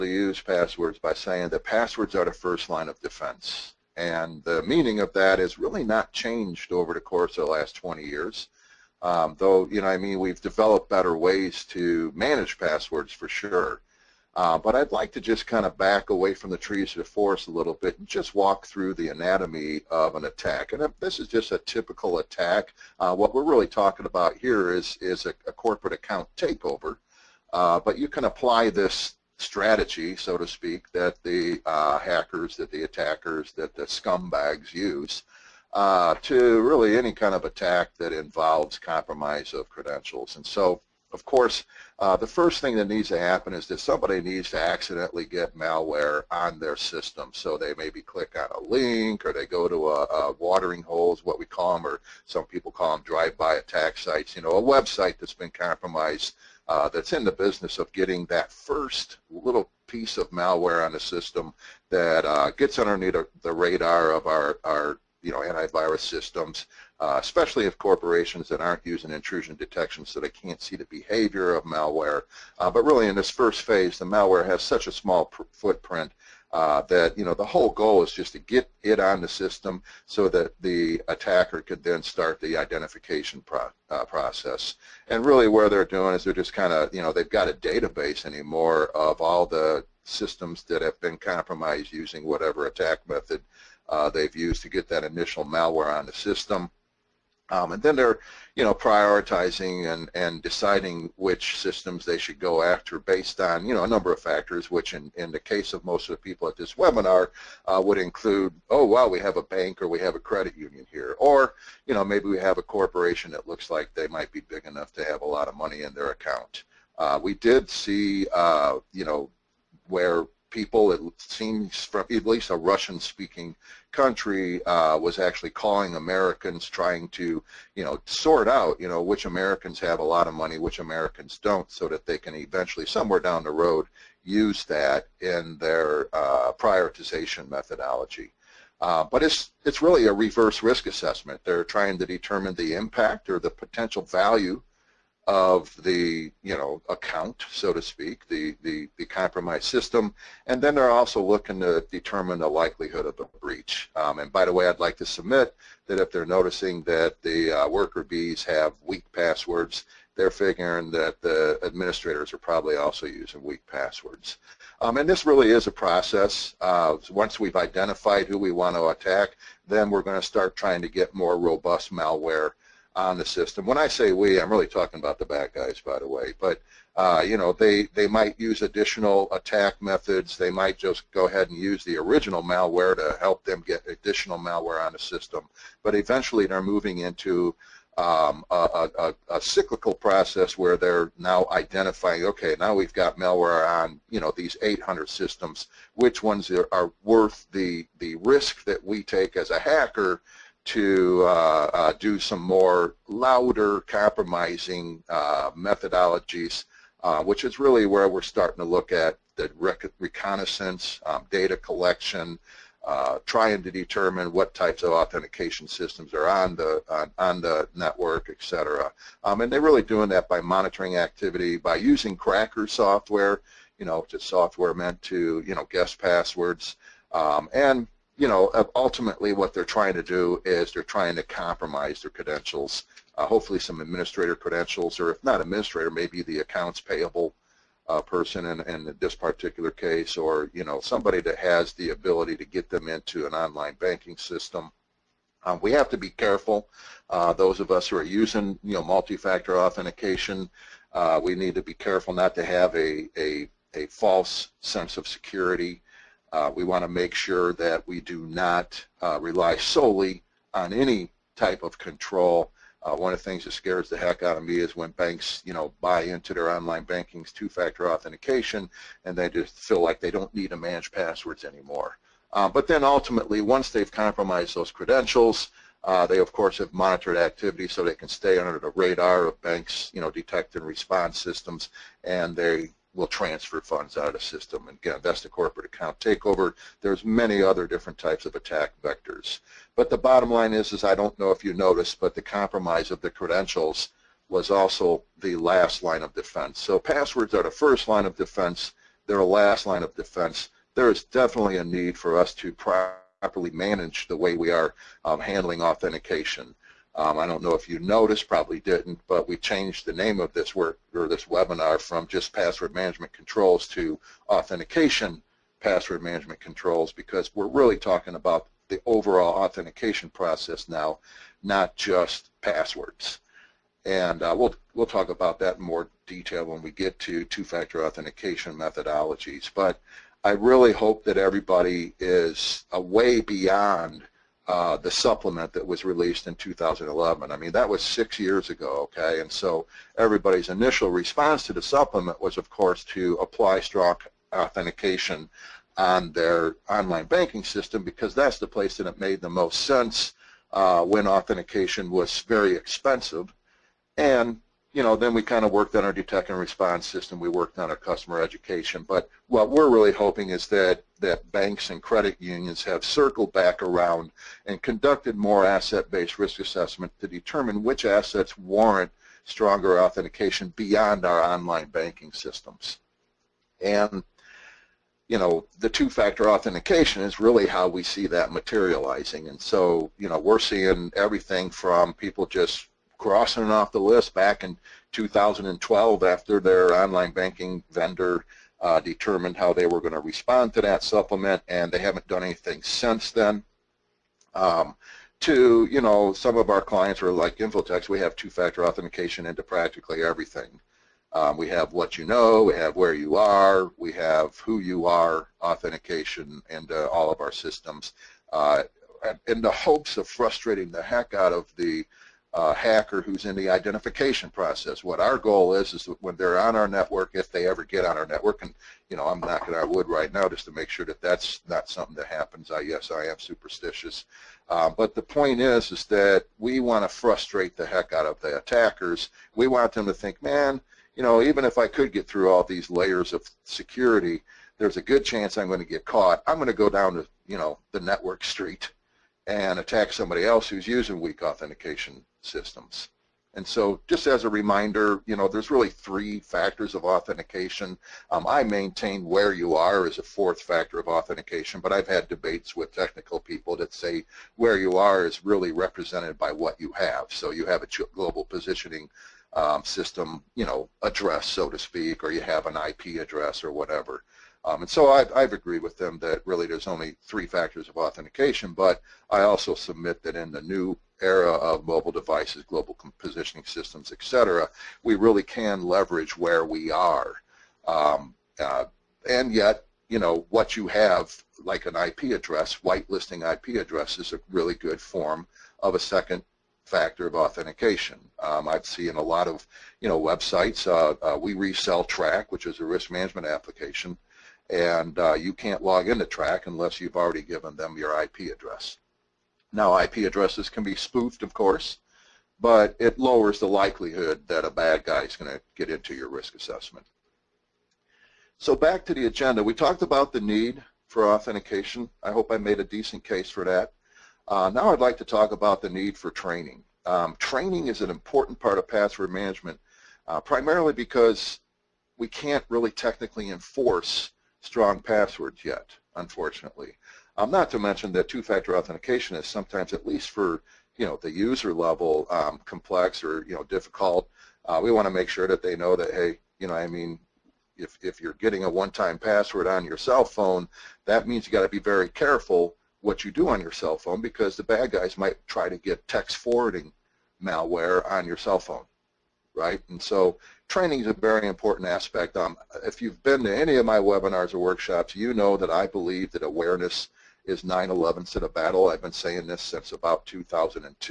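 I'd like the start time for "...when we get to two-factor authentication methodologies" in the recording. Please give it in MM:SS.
05:26.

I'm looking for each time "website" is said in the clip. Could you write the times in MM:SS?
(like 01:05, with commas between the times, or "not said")
00:54, 08:09.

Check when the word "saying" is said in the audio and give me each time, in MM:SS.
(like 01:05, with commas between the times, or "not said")
00:01, 09:18.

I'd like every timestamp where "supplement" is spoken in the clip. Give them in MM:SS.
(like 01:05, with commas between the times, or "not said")
05:34, 05:41, 06:30.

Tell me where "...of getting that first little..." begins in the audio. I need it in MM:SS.
00:57.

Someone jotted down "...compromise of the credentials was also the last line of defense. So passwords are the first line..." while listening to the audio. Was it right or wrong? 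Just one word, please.
right.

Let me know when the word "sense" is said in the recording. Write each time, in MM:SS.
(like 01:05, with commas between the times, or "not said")
04:14, 05:49.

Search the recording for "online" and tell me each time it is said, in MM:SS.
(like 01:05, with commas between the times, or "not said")
04:03, 04:26, 05:46, 06:11, 06:26.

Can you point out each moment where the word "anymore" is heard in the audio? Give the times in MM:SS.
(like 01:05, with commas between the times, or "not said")
01:28, 04:31.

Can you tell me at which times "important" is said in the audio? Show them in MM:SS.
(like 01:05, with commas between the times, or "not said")
08:37, 09:11.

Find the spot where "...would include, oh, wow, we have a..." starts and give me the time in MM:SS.
01:47.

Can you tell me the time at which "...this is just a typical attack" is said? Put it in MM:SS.
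00:20.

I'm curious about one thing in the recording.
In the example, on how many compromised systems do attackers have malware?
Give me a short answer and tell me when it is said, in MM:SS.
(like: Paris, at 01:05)
800, at 03:14.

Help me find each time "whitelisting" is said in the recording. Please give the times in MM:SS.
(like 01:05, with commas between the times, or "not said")
08:02.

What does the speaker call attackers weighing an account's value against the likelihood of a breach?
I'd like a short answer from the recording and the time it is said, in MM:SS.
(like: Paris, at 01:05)
Reverse risk assessment, at 02:20.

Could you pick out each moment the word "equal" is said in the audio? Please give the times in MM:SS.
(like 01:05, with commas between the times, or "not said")
not said.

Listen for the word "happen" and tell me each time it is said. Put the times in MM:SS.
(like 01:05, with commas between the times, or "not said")
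00:43, 07:02.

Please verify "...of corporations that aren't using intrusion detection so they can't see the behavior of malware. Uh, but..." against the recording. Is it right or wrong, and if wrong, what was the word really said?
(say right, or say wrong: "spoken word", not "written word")
right.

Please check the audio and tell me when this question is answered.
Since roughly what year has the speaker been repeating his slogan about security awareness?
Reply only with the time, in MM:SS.
09:20.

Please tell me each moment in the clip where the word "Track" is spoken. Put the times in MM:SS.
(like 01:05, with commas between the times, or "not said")
08:11, 08:16.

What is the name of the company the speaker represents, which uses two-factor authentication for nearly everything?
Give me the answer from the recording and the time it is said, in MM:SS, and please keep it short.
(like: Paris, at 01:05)
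Infotex, at 06:37.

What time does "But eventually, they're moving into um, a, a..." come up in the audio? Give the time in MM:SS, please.
03:05.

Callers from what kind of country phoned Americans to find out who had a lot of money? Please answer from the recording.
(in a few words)
Russian-speaking country.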